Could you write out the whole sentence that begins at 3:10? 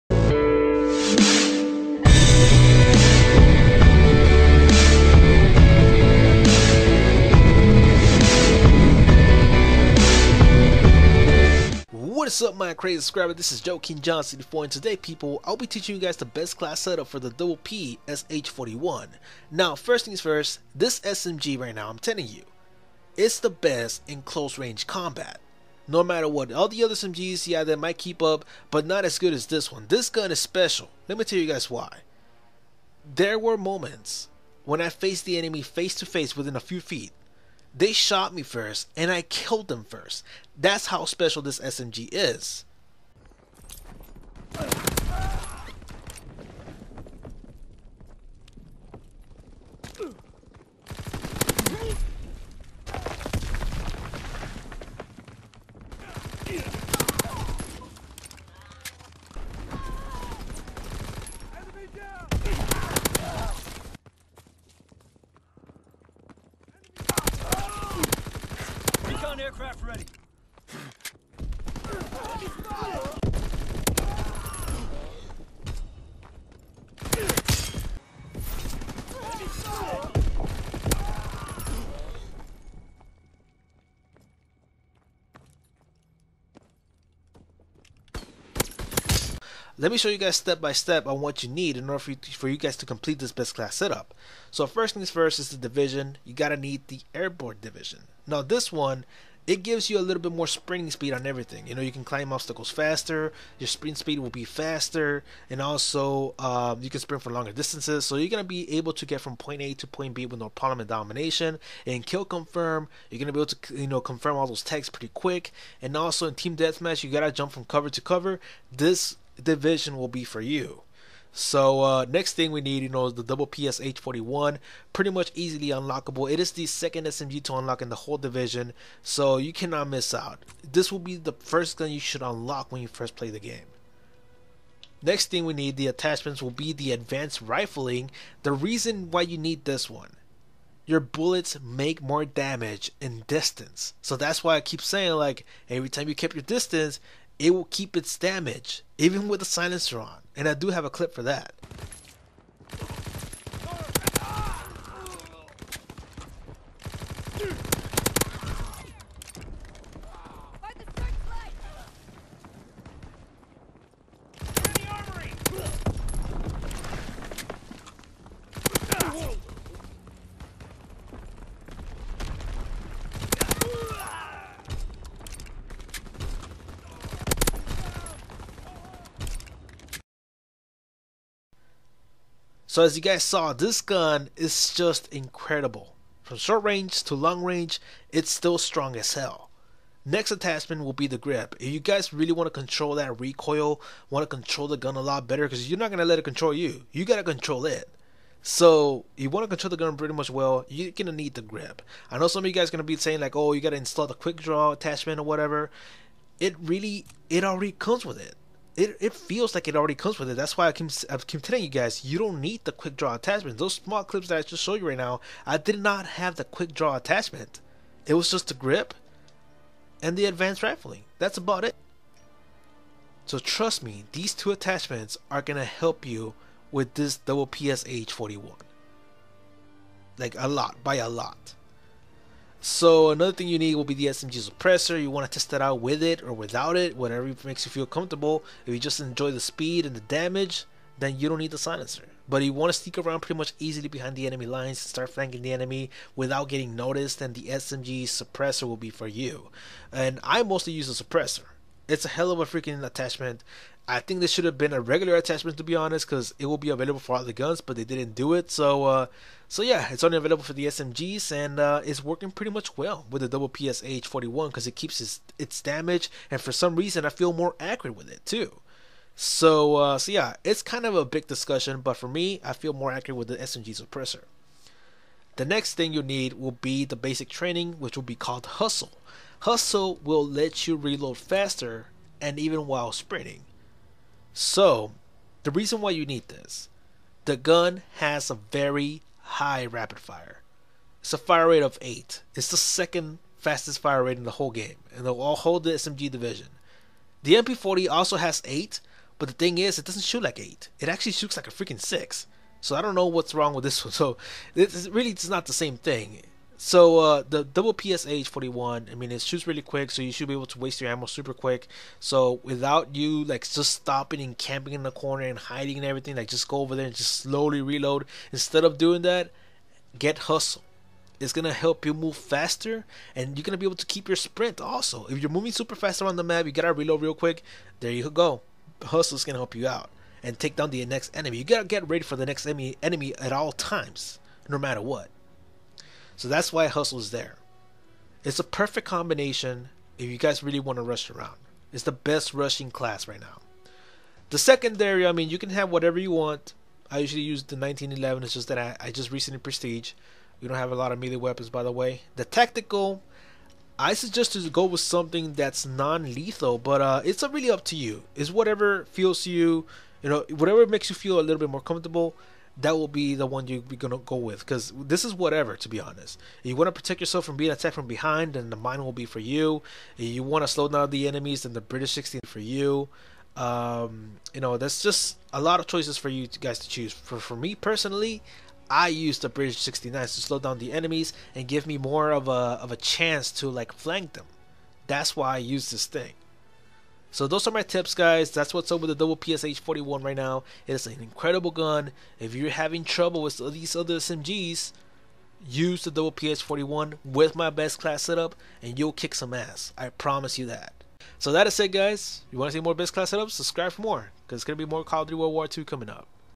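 Next attachment will be the grip.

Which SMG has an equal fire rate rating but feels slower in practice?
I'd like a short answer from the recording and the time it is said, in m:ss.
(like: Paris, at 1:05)
MP40, at 4:57.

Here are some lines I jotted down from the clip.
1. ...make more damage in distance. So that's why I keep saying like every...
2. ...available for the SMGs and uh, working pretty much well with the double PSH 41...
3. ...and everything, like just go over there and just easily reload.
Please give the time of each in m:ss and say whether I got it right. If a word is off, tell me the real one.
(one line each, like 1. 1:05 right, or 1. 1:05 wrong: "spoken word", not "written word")
1. 2:21 right
2. 4:20 right
3. 5:15 wrong: "slowly", not "easily".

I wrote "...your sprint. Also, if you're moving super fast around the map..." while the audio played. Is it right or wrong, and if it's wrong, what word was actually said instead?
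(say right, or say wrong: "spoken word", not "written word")
right.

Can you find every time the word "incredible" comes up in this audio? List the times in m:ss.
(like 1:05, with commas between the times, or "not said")
3:05, 6:31.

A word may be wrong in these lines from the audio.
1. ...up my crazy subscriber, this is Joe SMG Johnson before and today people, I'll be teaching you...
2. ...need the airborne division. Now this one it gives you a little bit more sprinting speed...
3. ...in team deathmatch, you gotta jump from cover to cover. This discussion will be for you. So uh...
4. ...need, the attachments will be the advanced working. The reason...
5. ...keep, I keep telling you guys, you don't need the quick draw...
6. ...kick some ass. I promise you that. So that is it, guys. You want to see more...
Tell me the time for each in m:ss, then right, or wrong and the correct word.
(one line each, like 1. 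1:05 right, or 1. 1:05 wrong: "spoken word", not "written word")
1. 0:12 wrong: "King", not "SMG"
2. 1:36 right
3. 1:56 wrong: "division", not "discussion"
4. 2:15 wrong: "rifling", not "working"
5. 3:30 right
6. 6:38 right.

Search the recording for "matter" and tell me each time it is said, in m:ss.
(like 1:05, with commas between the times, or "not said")
0:26, 5:34.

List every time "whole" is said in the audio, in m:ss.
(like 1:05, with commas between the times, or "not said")
2:07, 4:54.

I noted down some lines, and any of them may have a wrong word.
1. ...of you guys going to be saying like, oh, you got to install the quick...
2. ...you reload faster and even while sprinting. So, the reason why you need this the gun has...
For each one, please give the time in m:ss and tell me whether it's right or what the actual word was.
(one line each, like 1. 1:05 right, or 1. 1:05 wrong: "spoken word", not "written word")
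1. 3:22 right
2. 4:40 right.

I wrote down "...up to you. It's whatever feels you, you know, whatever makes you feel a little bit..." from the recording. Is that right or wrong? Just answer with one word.
right.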